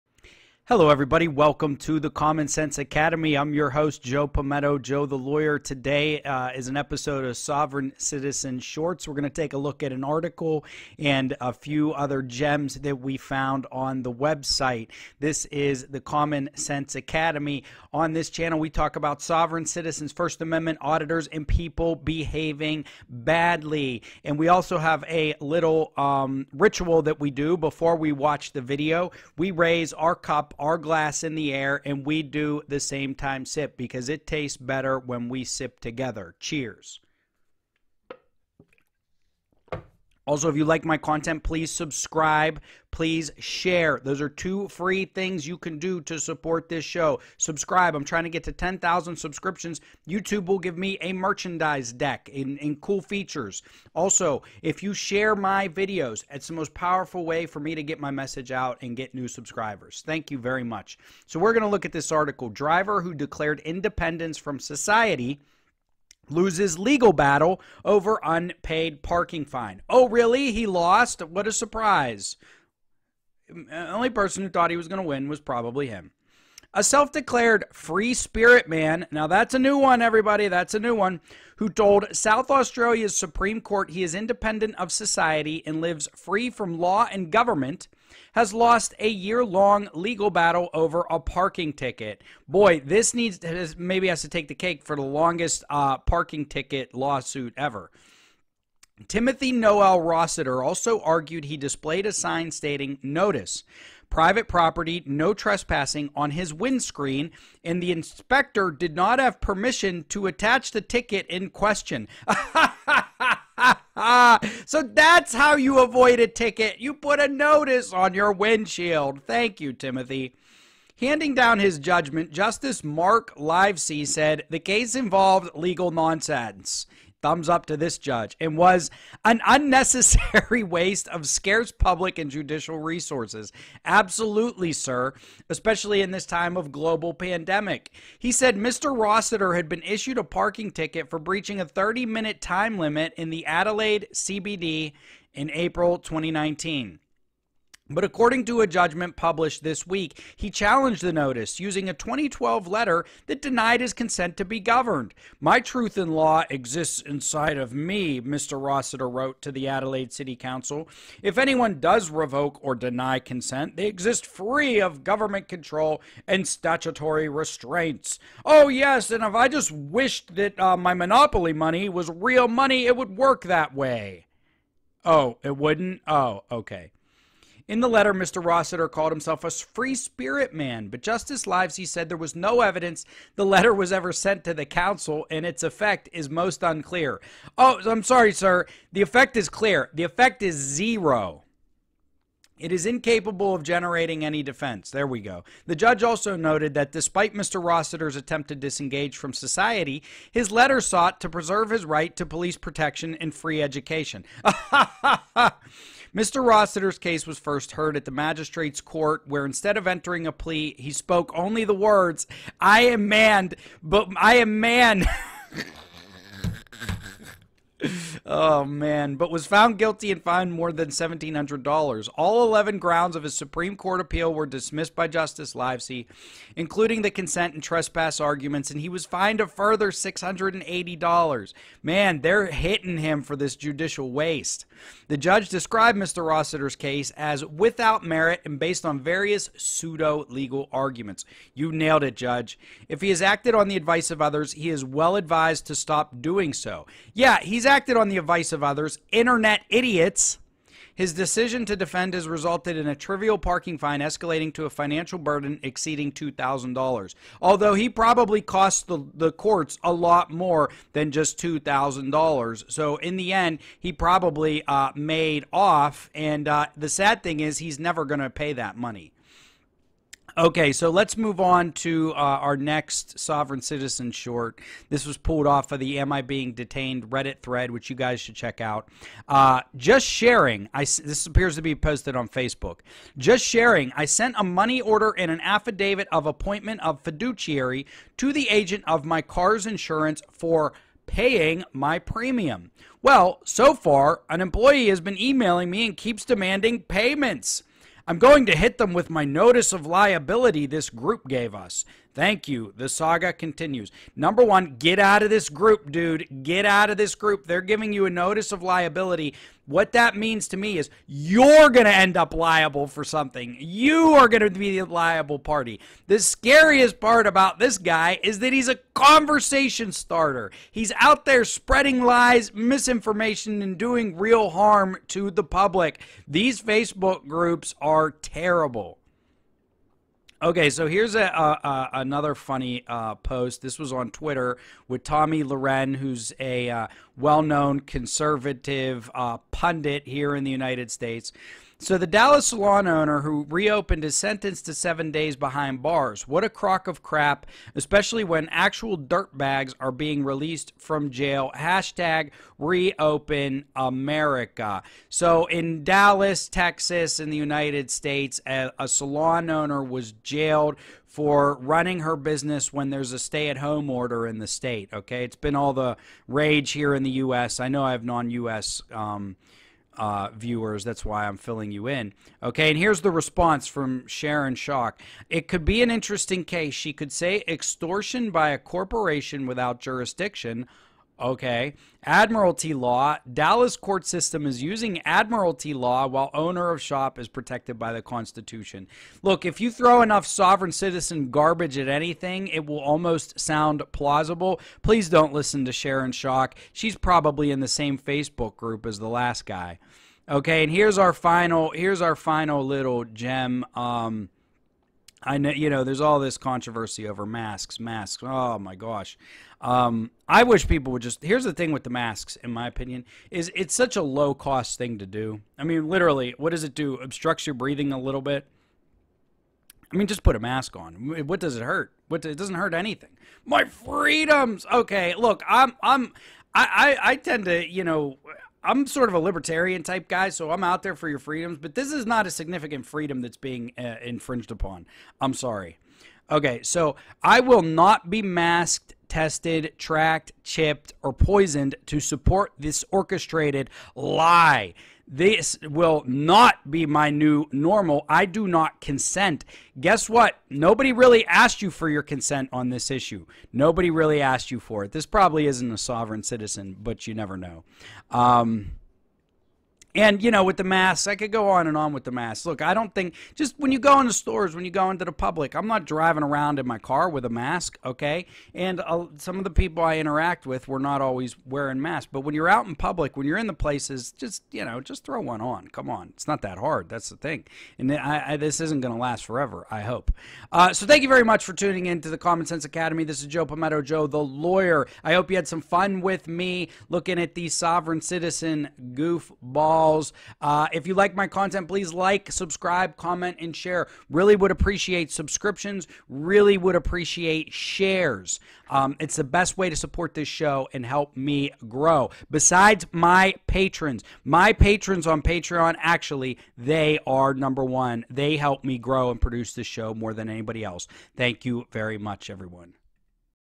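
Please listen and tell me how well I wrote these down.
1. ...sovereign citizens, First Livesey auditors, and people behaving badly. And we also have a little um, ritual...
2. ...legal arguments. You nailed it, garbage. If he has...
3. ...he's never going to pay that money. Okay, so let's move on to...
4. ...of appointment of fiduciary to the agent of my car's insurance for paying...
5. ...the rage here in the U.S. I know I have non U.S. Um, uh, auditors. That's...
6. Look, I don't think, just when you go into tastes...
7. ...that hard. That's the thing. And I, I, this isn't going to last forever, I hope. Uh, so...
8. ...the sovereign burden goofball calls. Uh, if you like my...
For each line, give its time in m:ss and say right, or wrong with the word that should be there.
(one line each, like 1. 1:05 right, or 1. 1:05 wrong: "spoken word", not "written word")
1. 0:19 wrong: "Amendment", not "Livesey"
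2. 4:00 wrong: "judge", not "garbage"
3. 4:27 right
4. 4:46 right
5. 6:05 wrong: "viewers", not "auditors"
6. 7:42 wrong: "stores", not "tastes"
7. 7:56 right
8. 8:07 wrong: "citizen", not "burden".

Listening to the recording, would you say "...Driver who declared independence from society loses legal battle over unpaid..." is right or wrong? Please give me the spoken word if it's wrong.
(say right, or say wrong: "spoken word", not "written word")
right.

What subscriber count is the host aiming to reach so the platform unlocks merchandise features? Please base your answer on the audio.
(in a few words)
10,000.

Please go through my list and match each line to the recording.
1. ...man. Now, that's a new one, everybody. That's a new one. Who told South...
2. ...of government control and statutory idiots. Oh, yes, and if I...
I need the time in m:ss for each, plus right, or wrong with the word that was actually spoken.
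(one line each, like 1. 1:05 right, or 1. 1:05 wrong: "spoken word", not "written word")
1. 1:18 right
2. 2:44 wrong: "restraints", not "idiots".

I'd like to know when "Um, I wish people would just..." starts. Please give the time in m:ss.
6:49.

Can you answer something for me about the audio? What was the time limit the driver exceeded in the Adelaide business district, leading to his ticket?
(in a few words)
30 minutes.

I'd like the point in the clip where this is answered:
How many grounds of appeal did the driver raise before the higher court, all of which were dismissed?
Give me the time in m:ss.
3:42.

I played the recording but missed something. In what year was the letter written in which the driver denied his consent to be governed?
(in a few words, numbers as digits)
2012.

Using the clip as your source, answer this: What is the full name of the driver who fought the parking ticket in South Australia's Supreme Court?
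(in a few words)
Timothy Noel Rossiter.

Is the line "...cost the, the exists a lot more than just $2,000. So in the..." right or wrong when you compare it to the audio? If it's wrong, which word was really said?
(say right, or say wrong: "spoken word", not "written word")
wrong: "courts", not "exists".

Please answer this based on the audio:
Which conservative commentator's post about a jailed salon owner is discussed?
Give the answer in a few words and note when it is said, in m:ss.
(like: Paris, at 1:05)
Tomi Lahren, at 5:35.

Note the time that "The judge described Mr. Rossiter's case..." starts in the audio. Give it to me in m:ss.
3:55.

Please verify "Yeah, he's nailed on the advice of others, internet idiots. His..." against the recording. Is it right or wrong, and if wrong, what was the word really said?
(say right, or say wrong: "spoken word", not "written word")
wrong: "acted", not "nailed".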